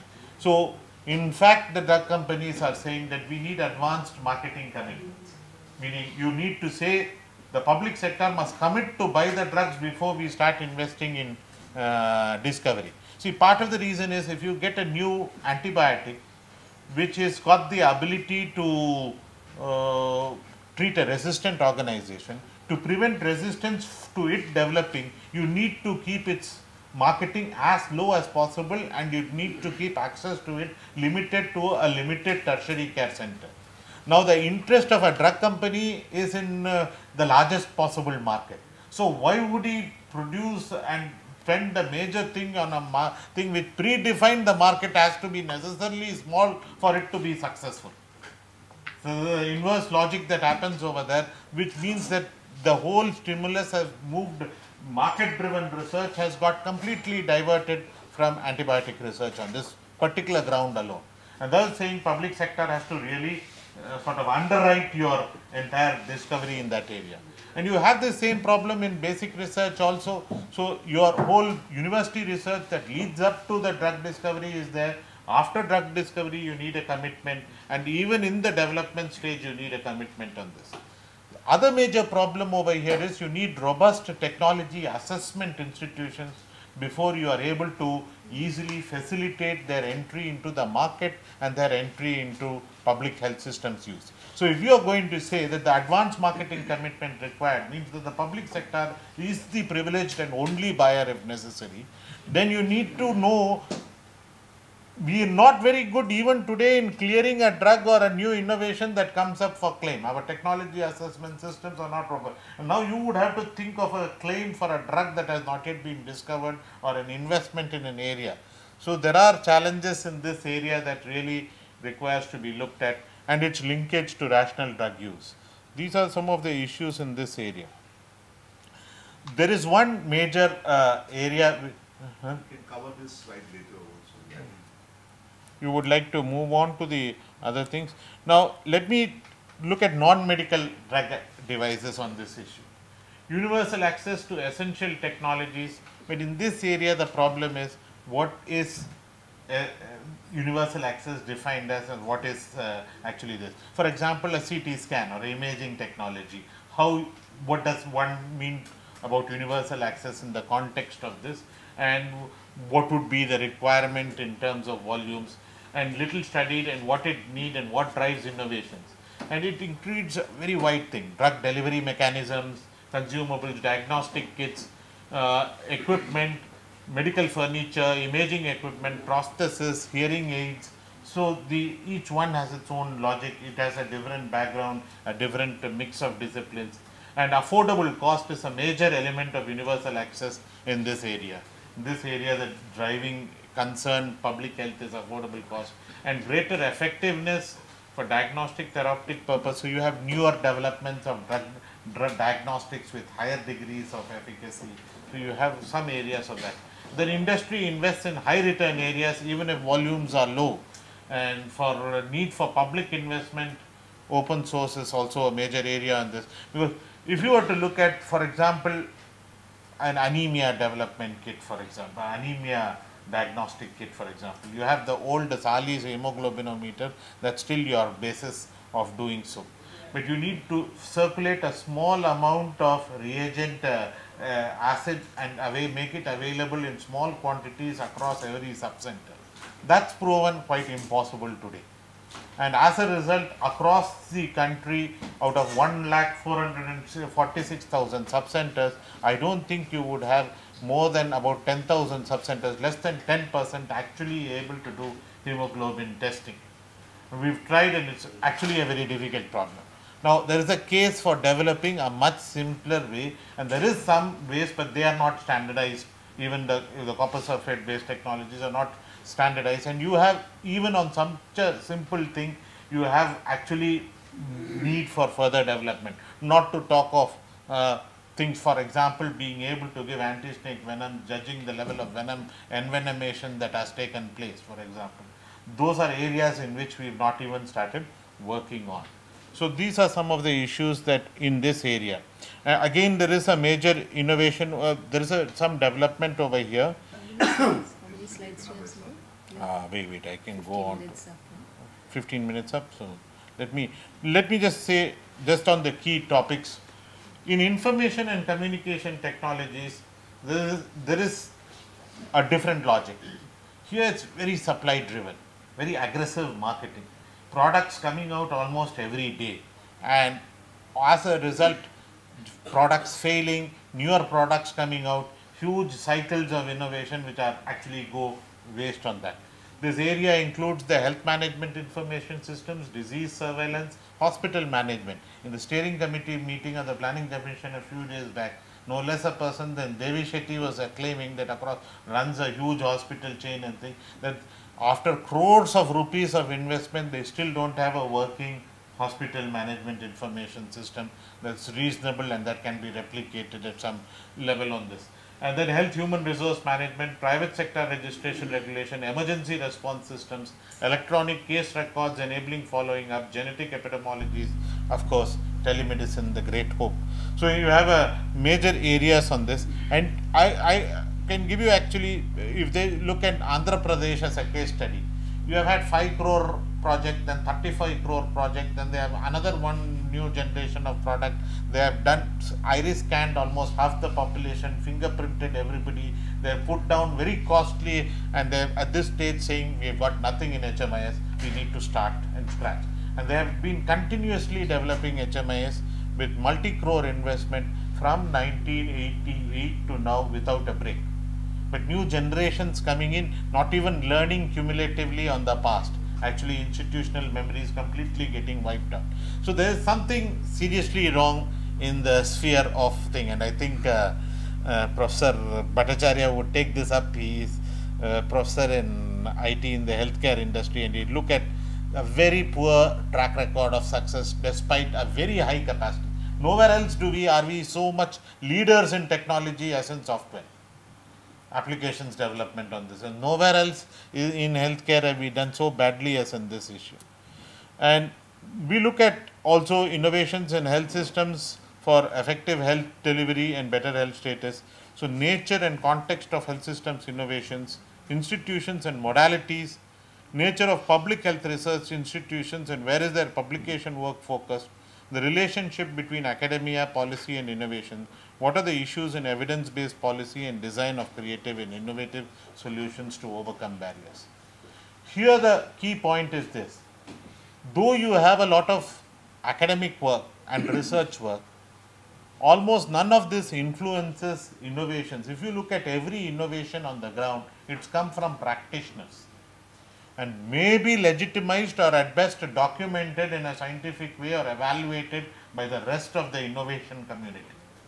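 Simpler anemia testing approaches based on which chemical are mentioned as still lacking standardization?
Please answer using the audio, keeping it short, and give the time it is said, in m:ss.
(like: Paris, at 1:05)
copper sulfate, at 4:26.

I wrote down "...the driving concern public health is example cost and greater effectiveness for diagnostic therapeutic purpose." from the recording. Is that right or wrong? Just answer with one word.
wrong.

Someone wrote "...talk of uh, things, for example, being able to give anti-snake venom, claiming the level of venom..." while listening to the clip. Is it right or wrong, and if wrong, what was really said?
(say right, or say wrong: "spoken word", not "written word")
wrong: "judging", not "claiming".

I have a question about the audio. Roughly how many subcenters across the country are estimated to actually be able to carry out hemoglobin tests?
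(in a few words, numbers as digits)
10,000.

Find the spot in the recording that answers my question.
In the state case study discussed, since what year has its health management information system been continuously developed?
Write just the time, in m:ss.
6:38.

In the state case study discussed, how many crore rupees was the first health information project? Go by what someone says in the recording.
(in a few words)
5 crore.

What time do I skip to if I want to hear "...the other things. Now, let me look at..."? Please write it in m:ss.
2:16.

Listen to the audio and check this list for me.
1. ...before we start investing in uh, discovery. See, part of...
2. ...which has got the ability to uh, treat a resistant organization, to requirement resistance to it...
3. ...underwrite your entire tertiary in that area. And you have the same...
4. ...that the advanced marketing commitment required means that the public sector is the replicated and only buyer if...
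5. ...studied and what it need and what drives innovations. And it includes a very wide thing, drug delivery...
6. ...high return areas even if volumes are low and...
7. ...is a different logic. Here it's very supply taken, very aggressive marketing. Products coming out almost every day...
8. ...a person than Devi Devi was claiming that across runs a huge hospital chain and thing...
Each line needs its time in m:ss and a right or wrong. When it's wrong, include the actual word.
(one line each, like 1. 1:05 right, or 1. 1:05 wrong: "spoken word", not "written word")
1. 0:09 right
2. 0:16 wrong: "prevent", not "requirement"
3. 1:04 wrong: "discovery", not "tertiary"
4. 1:35 wrong: "privileged", not "replicated"
5. 2:46 right
6. 3:28 right
7. 5:10 wrong: "driven", not "taken"
8. 5:39 wrong: "Shetty", not "Devi".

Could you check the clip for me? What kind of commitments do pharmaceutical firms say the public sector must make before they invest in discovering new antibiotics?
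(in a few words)
advanced marketing commitments.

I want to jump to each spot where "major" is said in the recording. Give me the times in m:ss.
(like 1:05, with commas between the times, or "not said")
0:41, 1:21, 2:10, 3:08, 3:35, 4:53, 6:08.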